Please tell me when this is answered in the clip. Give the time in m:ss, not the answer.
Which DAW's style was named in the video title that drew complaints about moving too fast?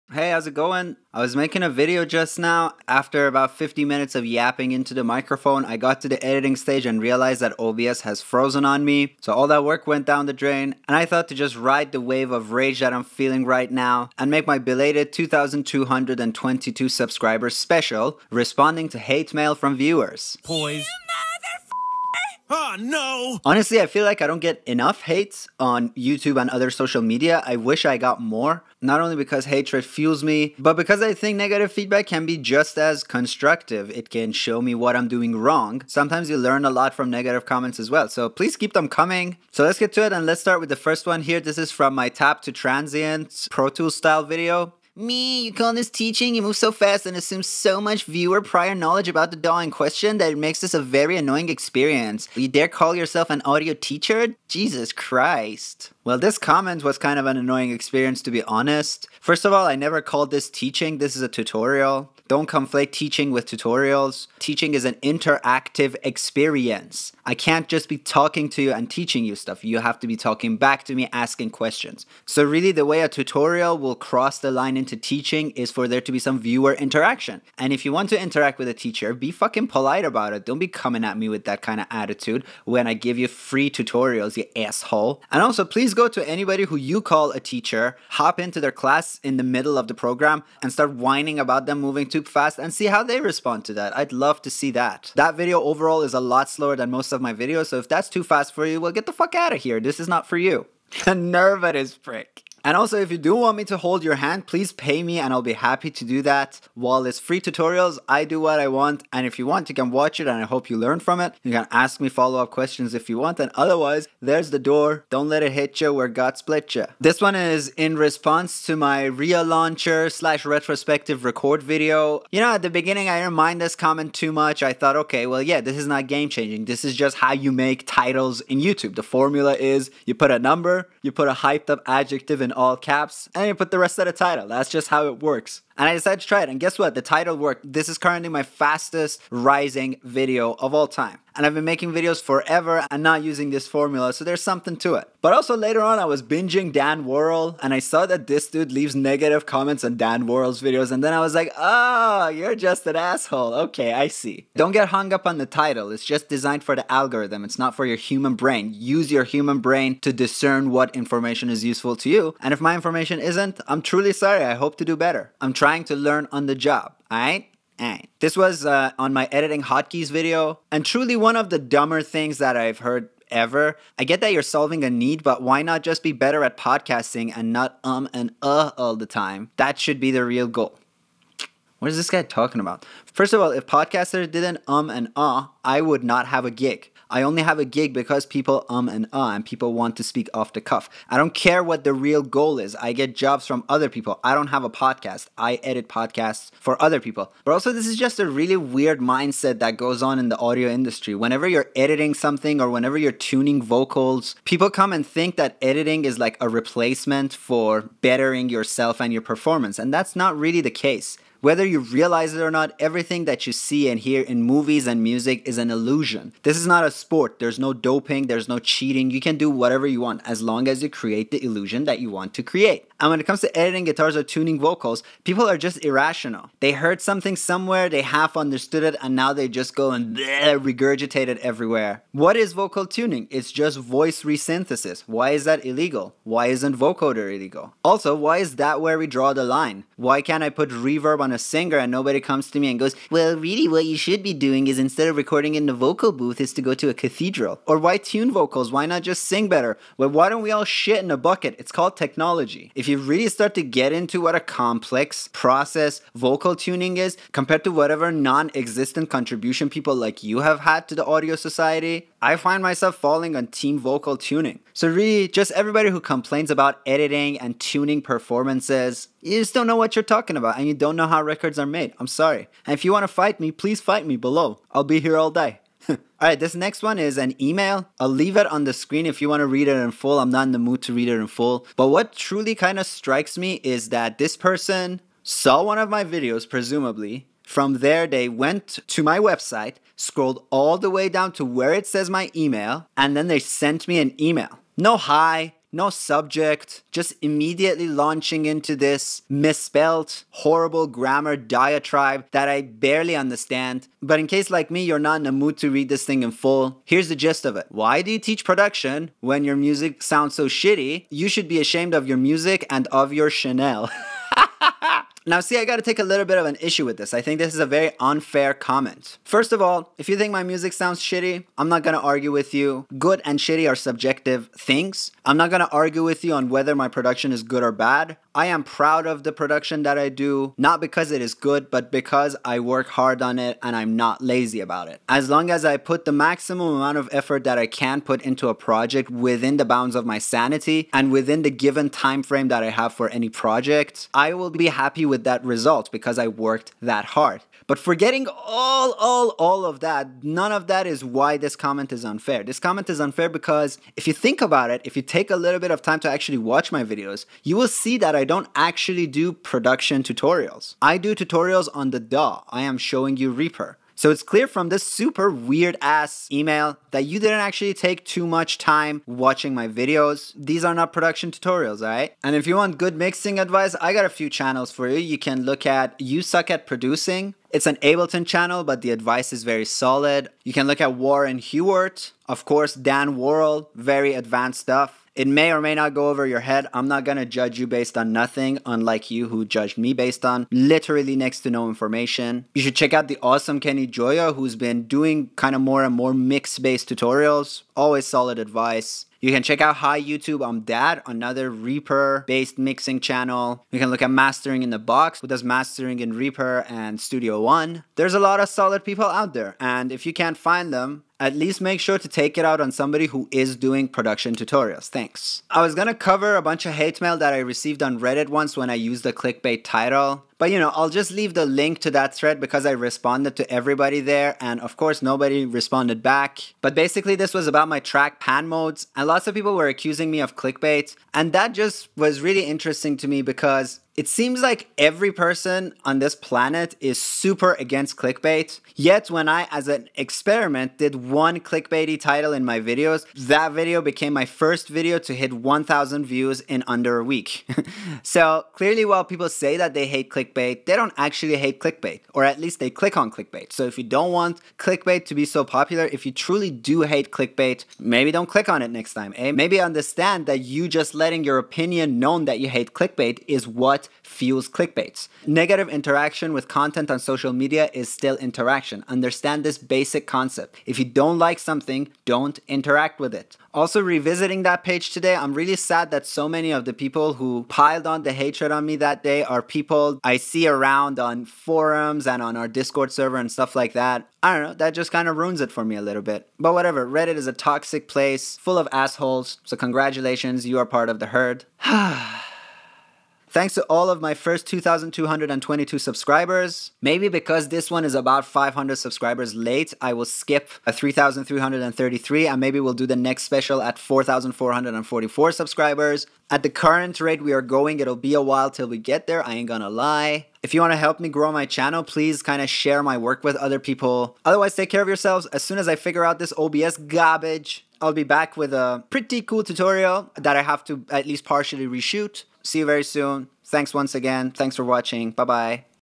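0:43.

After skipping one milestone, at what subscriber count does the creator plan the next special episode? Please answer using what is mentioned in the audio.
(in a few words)
4,444.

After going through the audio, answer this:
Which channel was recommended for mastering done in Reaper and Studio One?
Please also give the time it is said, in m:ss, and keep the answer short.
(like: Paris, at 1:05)
Mastering in the Box, at 6:44.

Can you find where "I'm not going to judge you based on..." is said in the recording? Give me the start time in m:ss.
6:26.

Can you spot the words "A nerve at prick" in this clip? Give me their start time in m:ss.
1:41.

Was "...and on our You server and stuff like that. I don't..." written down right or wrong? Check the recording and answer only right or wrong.
wrong.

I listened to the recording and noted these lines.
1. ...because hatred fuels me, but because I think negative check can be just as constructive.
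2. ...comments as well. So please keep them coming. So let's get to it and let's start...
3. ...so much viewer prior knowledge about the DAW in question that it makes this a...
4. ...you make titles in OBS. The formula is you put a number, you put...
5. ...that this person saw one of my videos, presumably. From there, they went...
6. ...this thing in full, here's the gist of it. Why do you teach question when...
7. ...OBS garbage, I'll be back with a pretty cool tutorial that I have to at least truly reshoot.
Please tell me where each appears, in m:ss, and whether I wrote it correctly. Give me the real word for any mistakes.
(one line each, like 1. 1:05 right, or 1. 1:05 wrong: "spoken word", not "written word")
1. 0:29 wrong: "feedback", not "check"
2. 0:37 right
3. 0:47 right
4. 2:07 wrong: "YouTube", not "OBS"
5. 4:43 right
6. 5:05 wrong: "production", not "question"
7. 8:36 wrong: "partially", not "truly".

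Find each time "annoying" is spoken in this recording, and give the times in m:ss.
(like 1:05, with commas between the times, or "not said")
0:51, 0:57.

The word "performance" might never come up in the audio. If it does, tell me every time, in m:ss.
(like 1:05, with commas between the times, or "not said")
3:29, 4:28.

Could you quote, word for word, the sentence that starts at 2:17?
This is currently my fastest rising video of all time.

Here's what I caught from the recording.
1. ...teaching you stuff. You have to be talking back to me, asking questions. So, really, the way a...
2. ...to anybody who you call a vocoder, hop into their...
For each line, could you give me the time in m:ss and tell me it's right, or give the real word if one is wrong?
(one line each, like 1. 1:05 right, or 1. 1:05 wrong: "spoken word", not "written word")
1. 1:08 right
2. 1:26 wrong: "teacher", not "vocoder".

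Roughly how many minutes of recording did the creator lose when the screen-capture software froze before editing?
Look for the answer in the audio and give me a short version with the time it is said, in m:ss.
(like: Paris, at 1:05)
50, at 0:03.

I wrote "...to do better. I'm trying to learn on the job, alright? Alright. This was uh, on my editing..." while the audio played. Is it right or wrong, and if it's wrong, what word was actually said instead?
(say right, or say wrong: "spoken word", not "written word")
right.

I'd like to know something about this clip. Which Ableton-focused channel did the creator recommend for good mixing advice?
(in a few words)
You Suck at Producing.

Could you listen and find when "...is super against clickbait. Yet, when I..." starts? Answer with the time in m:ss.
7:16.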